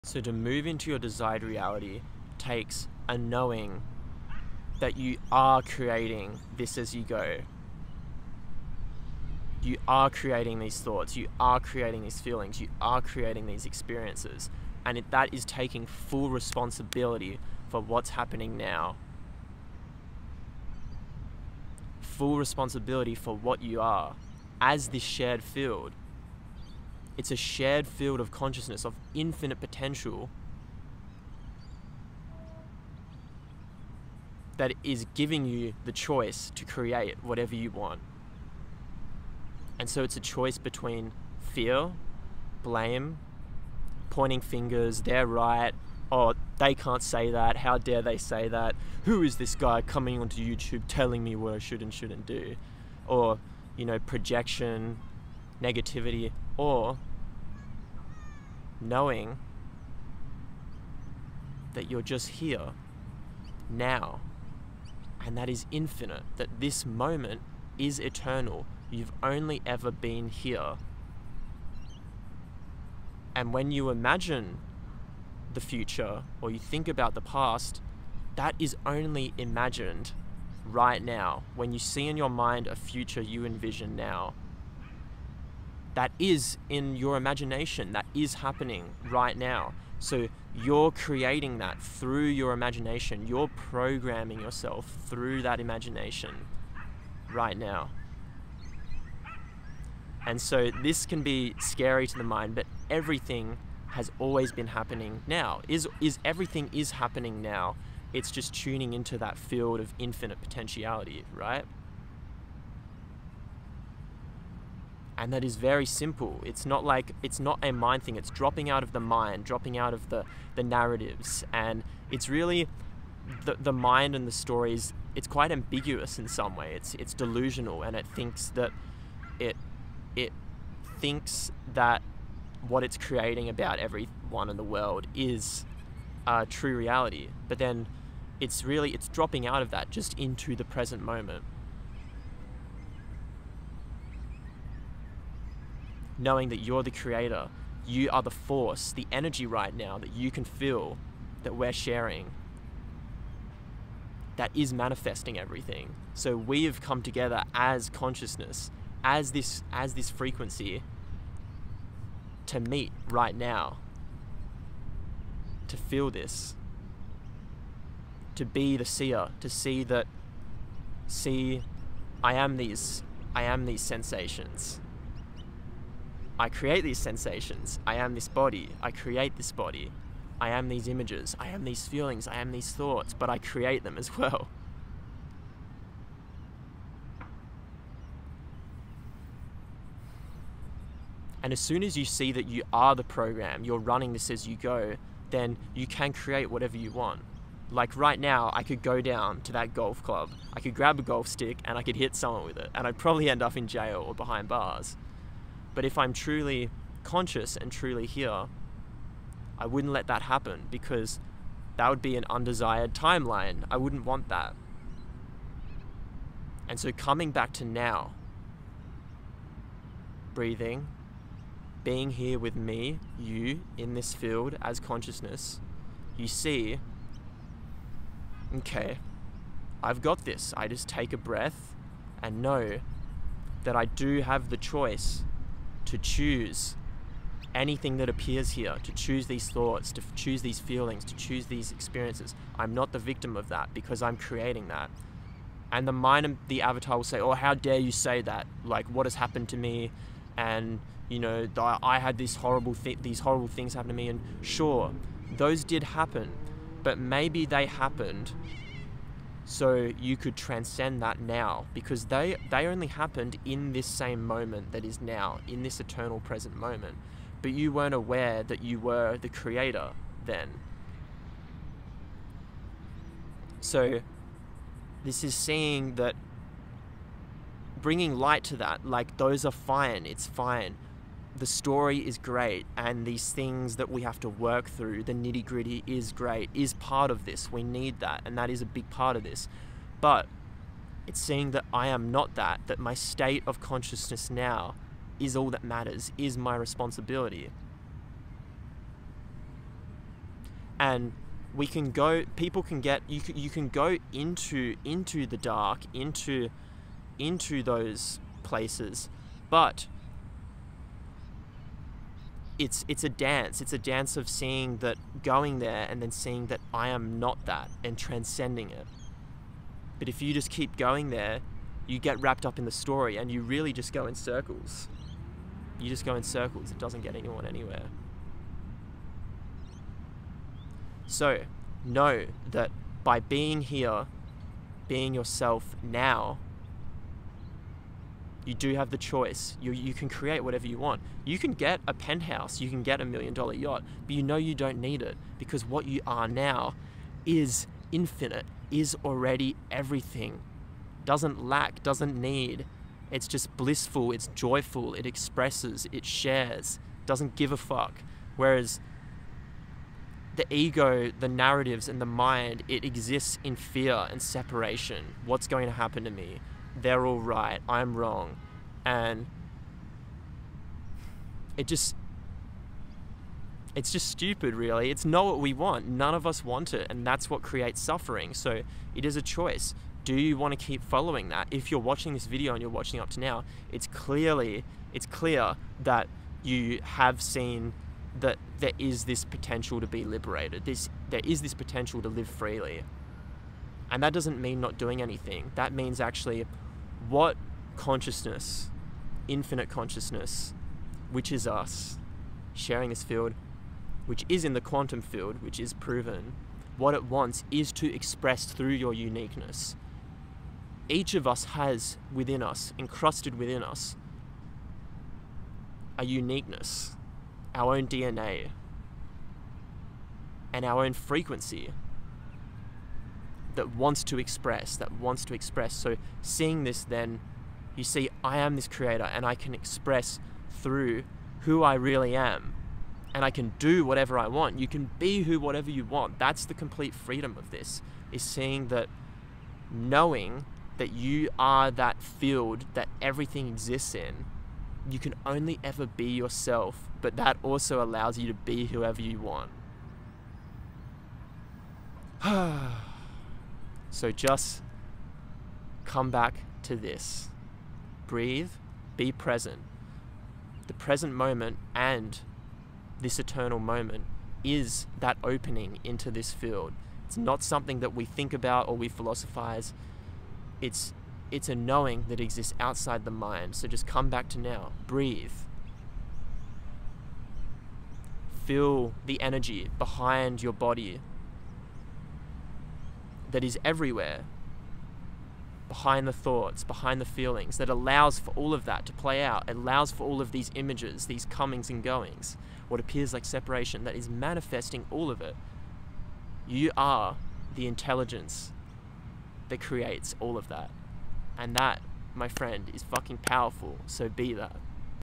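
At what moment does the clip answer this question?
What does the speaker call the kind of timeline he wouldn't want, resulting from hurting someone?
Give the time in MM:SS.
03:32.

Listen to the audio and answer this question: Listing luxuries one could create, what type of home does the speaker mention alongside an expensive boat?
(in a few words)
penthouse.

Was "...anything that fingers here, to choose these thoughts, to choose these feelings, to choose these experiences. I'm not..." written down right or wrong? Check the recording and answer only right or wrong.
wrong.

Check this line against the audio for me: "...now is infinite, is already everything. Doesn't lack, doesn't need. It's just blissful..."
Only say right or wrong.
right.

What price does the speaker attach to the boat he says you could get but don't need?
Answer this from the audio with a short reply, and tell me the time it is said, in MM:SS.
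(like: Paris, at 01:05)
$1,000,000, at 05:43.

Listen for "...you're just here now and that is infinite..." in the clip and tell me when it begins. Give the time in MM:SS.
01:01.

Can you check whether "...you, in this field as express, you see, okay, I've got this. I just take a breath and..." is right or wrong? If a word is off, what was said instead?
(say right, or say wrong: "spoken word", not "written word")
wrong: "consciousness", not "express".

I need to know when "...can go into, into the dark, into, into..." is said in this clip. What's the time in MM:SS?
05:03.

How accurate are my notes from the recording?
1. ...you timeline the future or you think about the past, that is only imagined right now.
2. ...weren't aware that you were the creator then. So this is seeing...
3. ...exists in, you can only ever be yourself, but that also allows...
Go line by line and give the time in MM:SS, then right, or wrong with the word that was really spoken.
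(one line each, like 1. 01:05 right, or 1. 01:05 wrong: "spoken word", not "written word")
1. 01:13 wrong: "imagine", not "timeline"
2. 04:27 right
3. 07:23 right.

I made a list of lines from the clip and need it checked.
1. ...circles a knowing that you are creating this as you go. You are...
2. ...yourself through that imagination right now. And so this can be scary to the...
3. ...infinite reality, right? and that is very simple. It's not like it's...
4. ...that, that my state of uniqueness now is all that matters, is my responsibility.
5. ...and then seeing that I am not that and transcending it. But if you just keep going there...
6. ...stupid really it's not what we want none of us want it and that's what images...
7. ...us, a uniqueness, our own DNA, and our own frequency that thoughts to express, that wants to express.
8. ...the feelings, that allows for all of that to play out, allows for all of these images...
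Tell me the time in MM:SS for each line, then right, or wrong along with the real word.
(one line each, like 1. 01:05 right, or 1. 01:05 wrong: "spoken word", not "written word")
1. 00:02 wrong: "takes", not "circles"
2. 01:34 right
3. 01:49 wrong: "potentiality", not "reality"
4. 04:52 wrong: "consciousness", not "uniqueness"
5. 05:15 right
6. 06:14 wrong: "creates", not "images"
7. 06:53 wrong: "wants", not "thoughts"
8. 08:06 right.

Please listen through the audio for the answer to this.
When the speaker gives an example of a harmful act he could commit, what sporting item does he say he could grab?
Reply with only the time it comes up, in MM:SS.
03:21.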